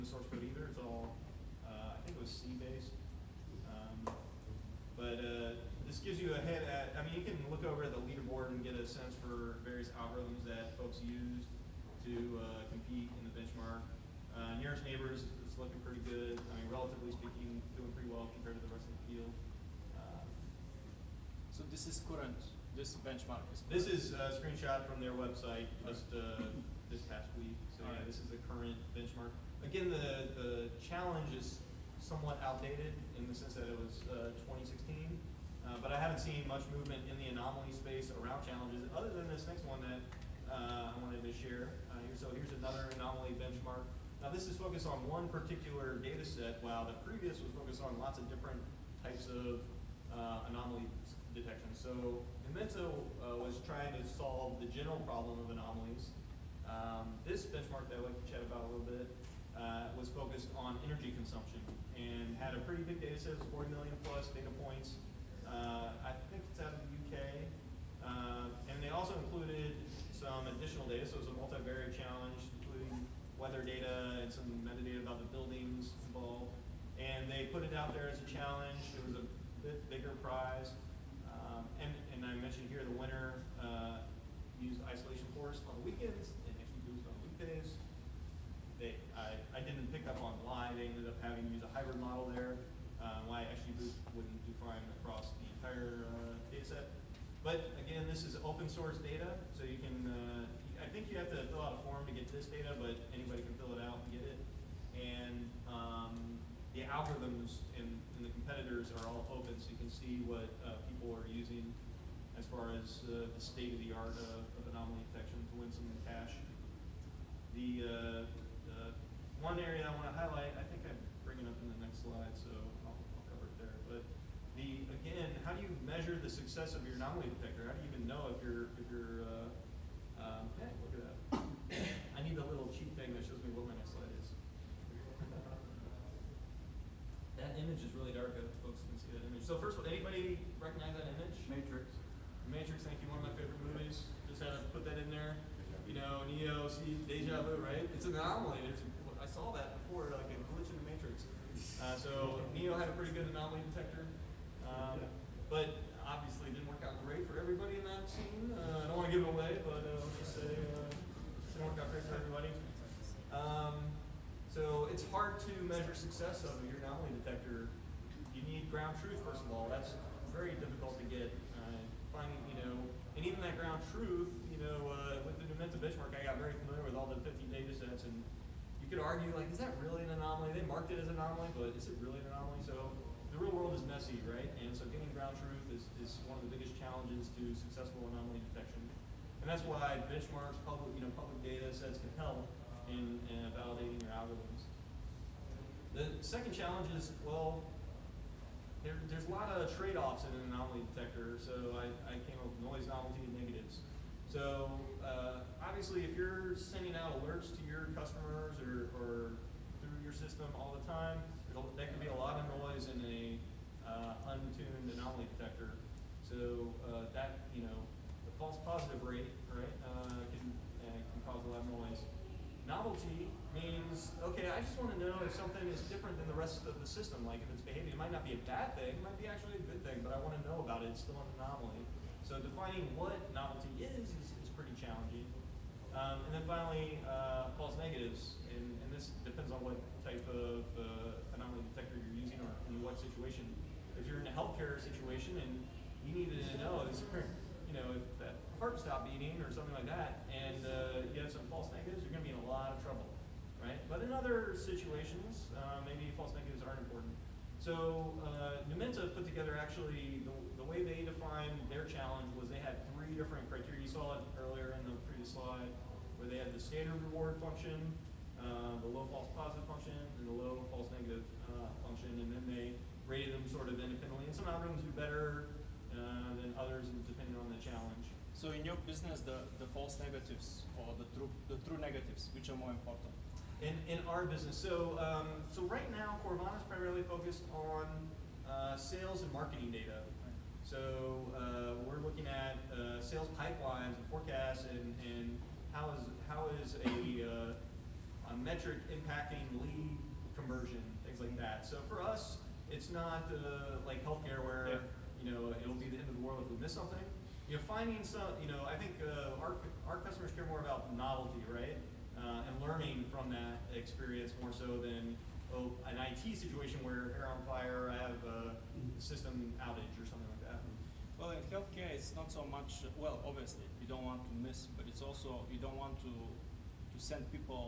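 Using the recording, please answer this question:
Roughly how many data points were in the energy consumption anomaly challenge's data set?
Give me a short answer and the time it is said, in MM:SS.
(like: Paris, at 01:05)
40 million plus, at 01:03.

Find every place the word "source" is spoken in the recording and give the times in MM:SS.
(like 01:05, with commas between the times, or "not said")
00:00, 01:38.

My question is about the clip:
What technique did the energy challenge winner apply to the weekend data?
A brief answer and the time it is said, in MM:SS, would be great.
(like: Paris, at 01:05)
Isolation forest, at 01:24.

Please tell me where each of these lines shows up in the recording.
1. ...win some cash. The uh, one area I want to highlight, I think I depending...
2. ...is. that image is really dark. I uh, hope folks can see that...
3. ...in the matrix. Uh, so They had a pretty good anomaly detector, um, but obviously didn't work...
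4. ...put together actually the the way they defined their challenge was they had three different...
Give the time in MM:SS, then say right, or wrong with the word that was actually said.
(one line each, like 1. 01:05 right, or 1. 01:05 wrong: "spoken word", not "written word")
1. 01:55 wrong: "bring", not "depending"
2. 02:14 right
3. 02:30 wrong: "Neo", not "They"
4. 04:19 right.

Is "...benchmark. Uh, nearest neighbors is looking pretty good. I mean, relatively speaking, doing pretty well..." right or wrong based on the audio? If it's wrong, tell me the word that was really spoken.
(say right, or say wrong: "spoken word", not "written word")
right.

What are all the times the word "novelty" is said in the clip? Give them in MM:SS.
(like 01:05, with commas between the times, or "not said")
03:22, 03:42, 03:53, 05:10.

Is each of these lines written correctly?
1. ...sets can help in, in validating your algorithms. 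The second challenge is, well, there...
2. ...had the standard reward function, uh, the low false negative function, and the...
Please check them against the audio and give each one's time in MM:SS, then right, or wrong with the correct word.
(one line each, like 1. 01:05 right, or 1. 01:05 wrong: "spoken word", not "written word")
1. 03:11 right
2. 04:26 wrong: "positive", not "negative".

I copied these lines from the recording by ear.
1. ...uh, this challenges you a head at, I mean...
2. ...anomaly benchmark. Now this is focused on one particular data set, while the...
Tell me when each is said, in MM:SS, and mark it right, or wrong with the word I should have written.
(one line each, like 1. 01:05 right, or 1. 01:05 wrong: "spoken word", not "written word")
1. 00:05 wrong: "gives", not "challenges"
2. 00:42 right.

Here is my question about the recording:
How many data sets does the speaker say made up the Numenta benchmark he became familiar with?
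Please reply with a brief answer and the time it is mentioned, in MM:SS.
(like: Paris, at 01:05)
50, at 02:57.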